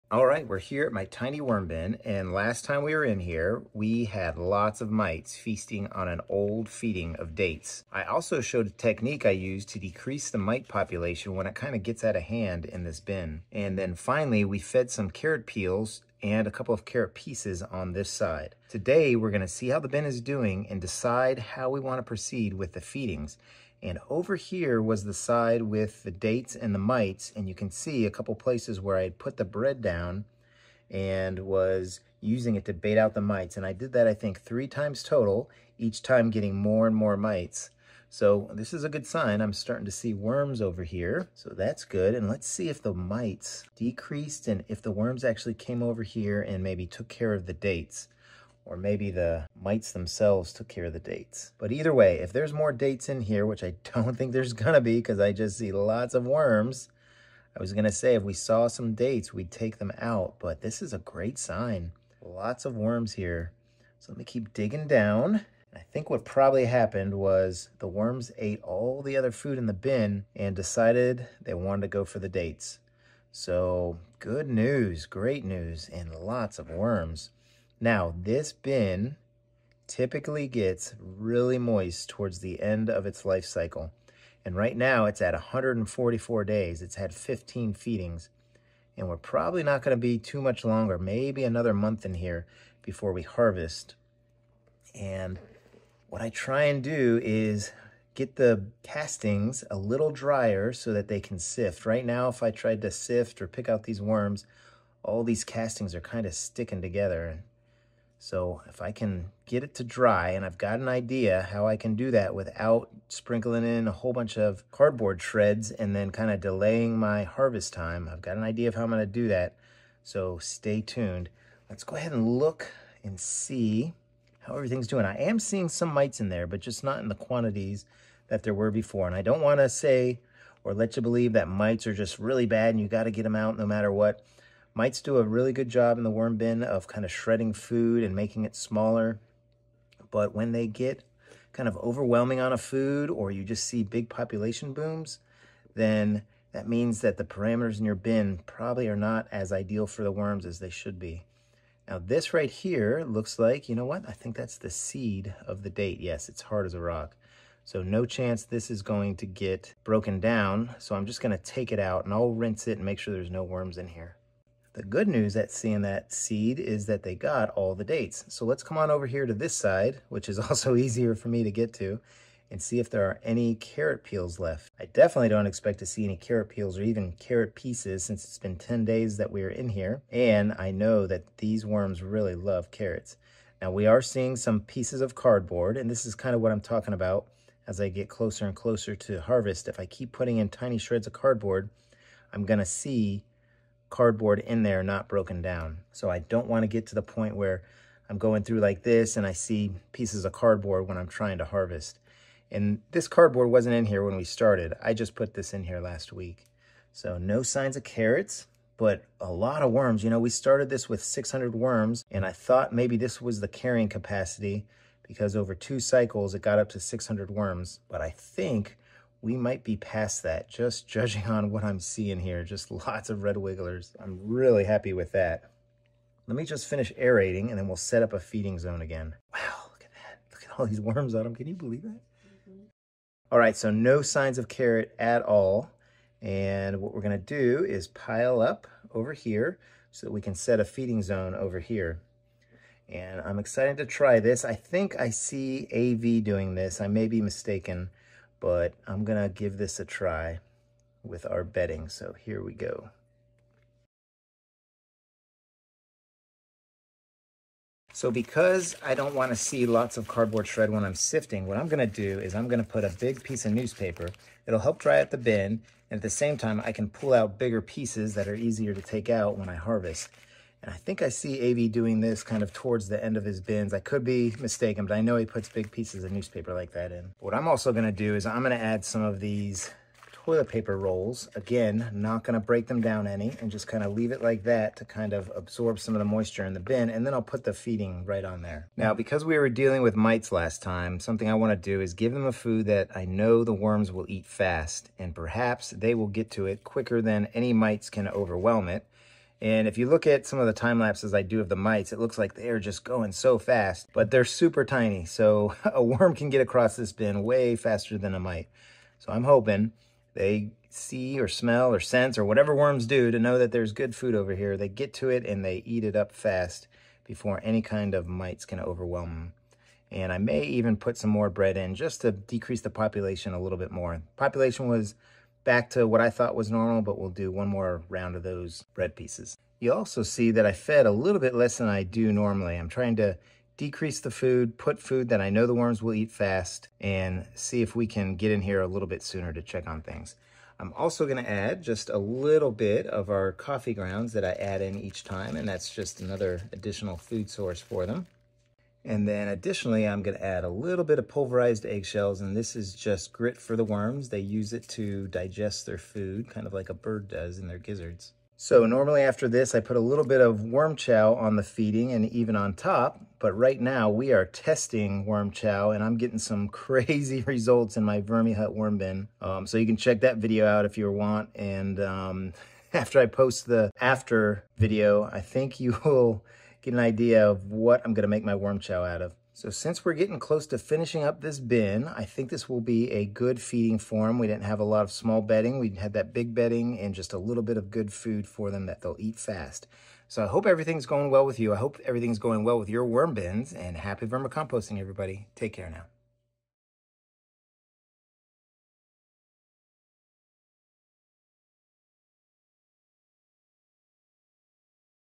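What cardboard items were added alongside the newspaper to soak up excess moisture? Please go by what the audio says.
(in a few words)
toilet paper rolls.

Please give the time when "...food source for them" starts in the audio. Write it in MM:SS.
05:46.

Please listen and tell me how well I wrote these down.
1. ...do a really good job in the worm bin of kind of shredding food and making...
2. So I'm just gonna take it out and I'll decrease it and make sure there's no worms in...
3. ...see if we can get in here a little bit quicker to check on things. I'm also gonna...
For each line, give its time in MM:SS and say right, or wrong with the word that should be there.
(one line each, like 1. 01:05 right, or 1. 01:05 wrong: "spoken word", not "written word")
1. 02:15 right
2. 02:40 wrong: "rinse", not "decrease"
3. 05:37 wrong: "sooner", not "quicker".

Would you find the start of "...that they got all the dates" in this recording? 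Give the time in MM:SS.
02:46.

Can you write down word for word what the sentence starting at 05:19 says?
And I may even put some more bread in just to decrease the population a little bit more.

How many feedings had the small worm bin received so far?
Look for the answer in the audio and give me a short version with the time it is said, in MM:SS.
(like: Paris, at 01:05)
15, at 01:27.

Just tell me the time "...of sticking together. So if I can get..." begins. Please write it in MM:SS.
01:46.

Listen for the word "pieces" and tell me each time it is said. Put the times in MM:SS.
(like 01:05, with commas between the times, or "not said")
00:17, 02:57, 03:04, 03:19, 04:23, 04:27, 04:35, 05:28.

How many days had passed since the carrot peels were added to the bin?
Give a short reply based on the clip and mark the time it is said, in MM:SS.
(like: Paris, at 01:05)
10 days, at 02:58.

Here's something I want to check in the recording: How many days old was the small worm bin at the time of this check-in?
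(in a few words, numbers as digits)
144 days.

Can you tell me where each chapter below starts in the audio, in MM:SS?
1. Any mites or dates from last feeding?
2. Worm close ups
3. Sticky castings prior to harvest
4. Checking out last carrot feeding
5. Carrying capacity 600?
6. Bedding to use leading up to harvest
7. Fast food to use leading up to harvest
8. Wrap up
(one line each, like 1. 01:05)
1. 00:42
2. 01:12
3. 01:37
4. 02:48
5. 03:30
6. 04:18
7. 04:49
8. 05:59.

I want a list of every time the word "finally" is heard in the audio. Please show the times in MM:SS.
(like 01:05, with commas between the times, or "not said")
00:13.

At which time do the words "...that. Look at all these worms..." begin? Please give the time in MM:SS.
03:49.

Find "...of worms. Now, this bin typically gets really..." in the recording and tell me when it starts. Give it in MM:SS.
01:16.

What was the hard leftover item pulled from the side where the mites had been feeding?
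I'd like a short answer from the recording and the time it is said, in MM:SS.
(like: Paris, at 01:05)
seed of the date, at 02:34.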